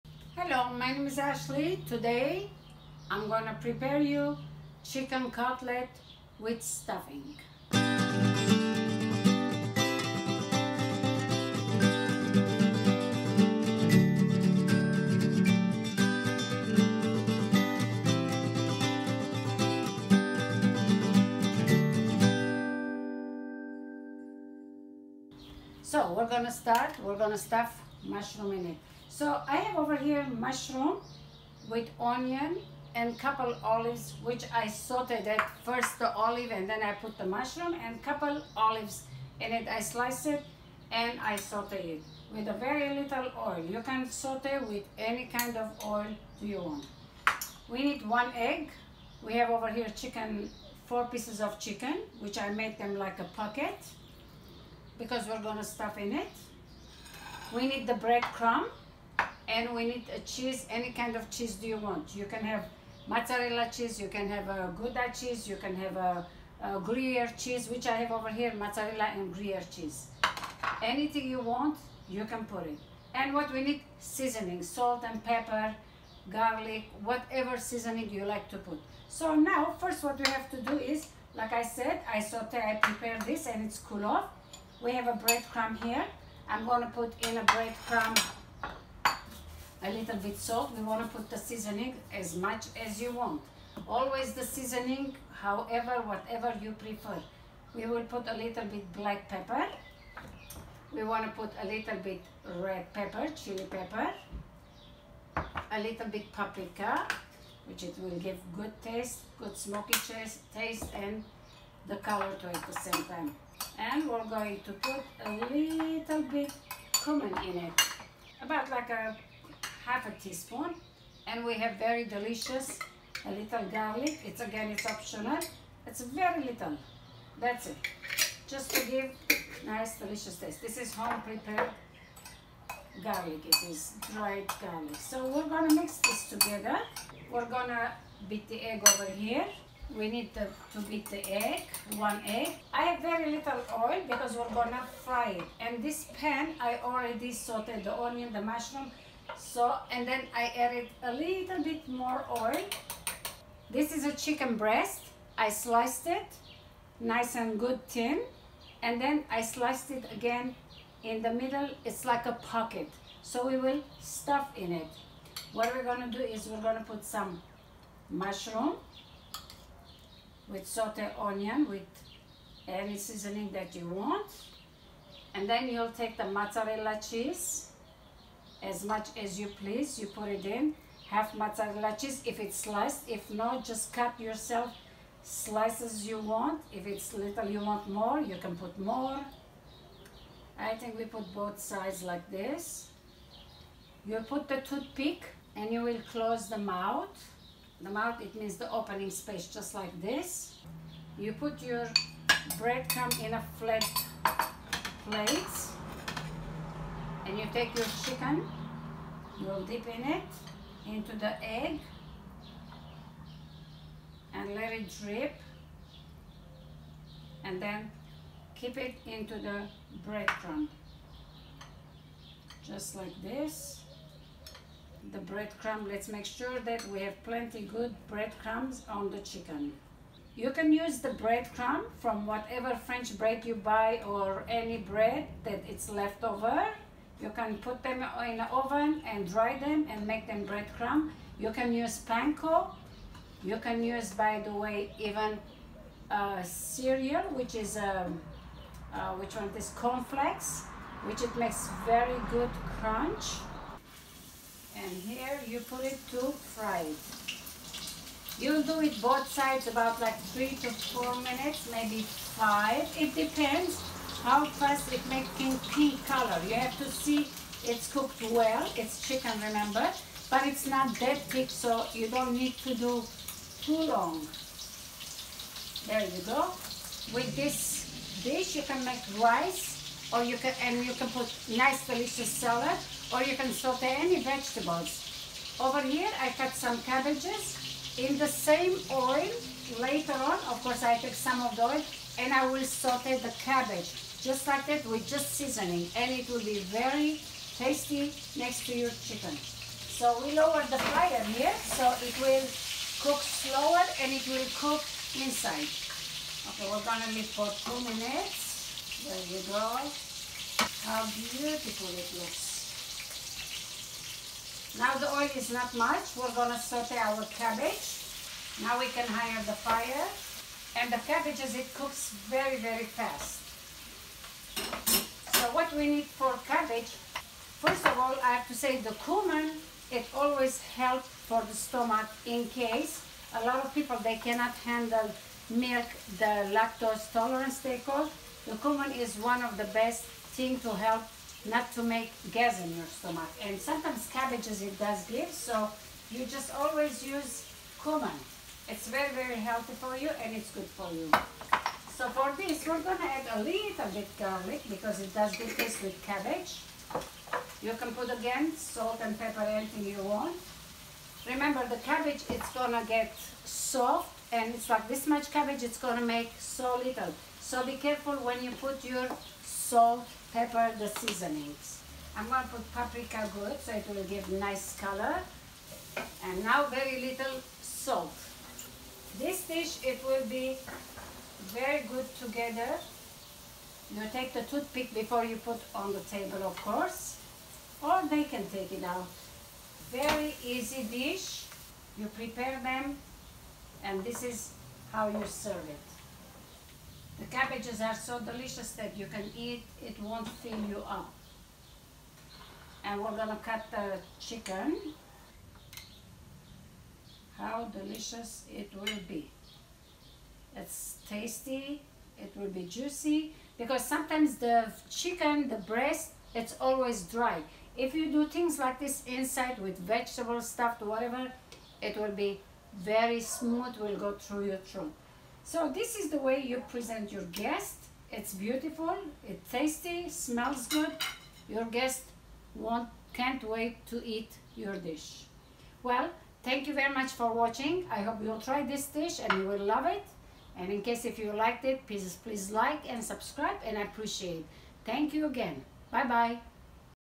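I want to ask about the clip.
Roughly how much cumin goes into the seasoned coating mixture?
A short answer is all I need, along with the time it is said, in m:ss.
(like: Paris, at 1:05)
Half a teaspoon, at 1:58.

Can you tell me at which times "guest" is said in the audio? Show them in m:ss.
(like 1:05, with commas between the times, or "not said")
7:07, 7:11.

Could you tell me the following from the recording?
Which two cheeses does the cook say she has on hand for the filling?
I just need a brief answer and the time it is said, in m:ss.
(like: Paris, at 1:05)
Mozzarella and gruyere, at 1:08.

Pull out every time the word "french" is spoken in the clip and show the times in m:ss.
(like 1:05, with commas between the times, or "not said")
3:52.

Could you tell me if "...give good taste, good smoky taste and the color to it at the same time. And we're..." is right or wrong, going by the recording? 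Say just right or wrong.
right.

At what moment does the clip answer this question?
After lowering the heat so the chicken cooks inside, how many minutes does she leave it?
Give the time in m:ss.
5:07.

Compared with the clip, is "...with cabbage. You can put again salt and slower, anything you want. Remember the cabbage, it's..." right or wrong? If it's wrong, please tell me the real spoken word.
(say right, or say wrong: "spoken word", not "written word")
wrong: "pepper", not "slower".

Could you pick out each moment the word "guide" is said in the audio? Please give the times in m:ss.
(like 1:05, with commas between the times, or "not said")
not said.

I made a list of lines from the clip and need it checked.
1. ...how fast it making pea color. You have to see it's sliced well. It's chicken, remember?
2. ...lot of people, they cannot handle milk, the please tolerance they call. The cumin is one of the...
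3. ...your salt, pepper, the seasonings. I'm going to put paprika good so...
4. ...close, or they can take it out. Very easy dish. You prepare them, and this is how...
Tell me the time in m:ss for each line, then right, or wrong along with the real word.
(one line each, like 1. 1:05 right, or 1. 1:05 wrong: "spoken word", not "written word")
1. 4:24 wrong: "cooked", not "sliced"
2. 5:33 wrong: "lactose", not "please"
3. 6:08 right
4. 6:26 wrong: "course", not "close".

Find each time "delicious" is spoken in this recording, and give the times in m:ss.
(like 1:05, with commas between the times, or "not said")
2:02, 2:09, 4:41, 6:38, 6:47.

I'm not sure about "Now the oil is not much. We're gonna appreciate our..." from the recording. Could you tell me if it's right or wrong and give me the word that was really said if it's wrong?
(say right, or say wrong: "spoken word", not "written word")
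wrong: "saute", not "appreciate".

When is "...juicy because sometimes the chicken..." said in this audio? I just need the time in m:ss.
6:52.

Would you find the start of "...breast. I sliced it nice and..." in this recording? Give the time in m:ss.
2:34.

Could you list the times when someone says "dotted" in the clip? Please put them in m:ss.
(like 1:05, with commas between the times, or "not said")
not said.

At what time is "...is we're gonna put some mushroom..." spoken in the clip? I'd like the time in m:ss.
2:46.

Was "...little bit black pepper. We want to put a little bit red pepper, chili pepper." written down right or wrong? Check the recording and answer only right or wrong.
right.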